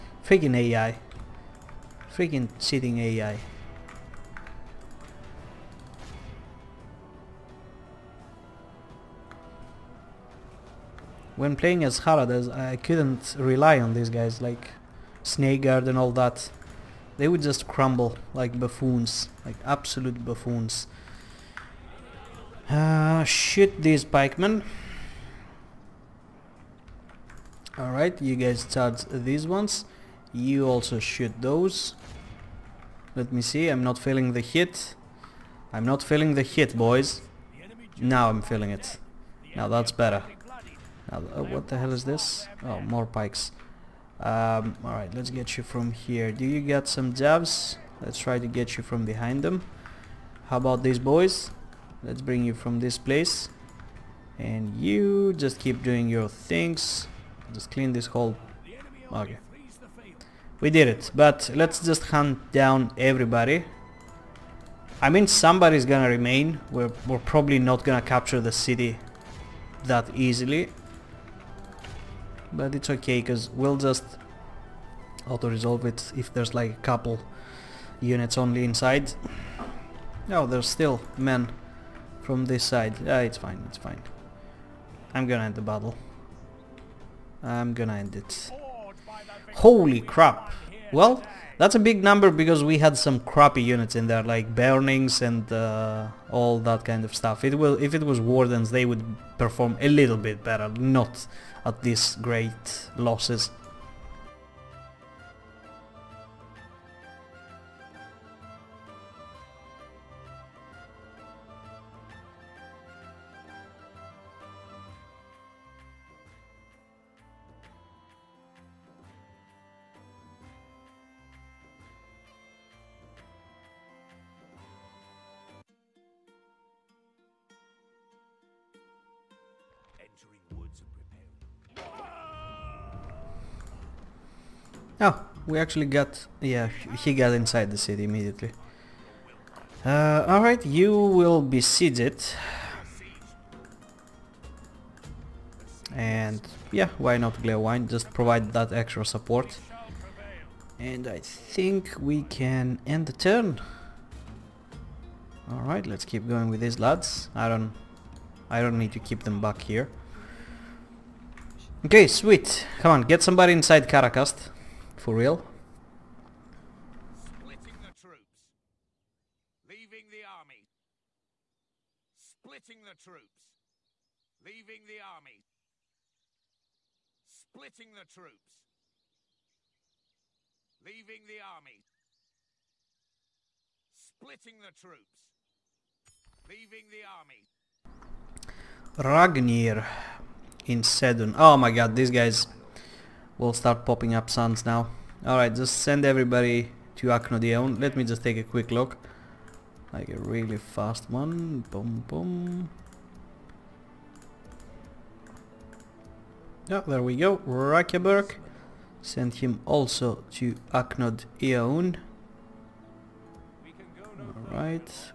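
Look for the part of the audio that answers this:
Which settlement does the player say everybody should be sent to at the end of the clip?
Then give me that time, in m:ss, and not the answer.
3:17.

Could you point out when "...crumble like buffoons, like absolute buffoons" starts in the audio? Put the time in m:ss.
0:17.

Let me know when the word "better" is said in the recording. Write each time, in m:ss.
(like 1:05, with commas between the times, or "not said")
0:39, 1:40.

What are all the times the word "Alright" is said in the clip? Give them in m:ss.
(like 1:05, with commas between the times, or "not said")
0:27, 0:44, 2:20, 2:35, 3:15, 3:34.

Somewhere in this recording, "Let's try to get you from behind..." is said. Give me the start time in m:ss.
0:48.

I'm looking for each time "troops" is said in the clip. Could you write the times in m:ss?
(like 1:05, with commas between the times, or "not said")
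2:47, 2:53, 2:58, 3:04.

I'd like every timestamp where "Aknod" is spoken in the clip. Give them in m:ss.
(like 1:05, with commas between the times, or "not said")
3:30.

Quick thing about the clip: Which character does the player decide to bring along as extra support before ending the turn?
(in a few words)
Glewine.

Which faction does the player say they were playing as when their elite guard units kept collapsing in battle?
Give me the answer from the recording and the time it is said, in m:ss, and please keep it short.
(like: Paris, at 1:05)
Haradas, at 0:12.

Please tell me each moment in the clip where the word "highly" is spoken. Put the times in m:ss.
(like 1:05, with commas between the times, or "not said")
not said.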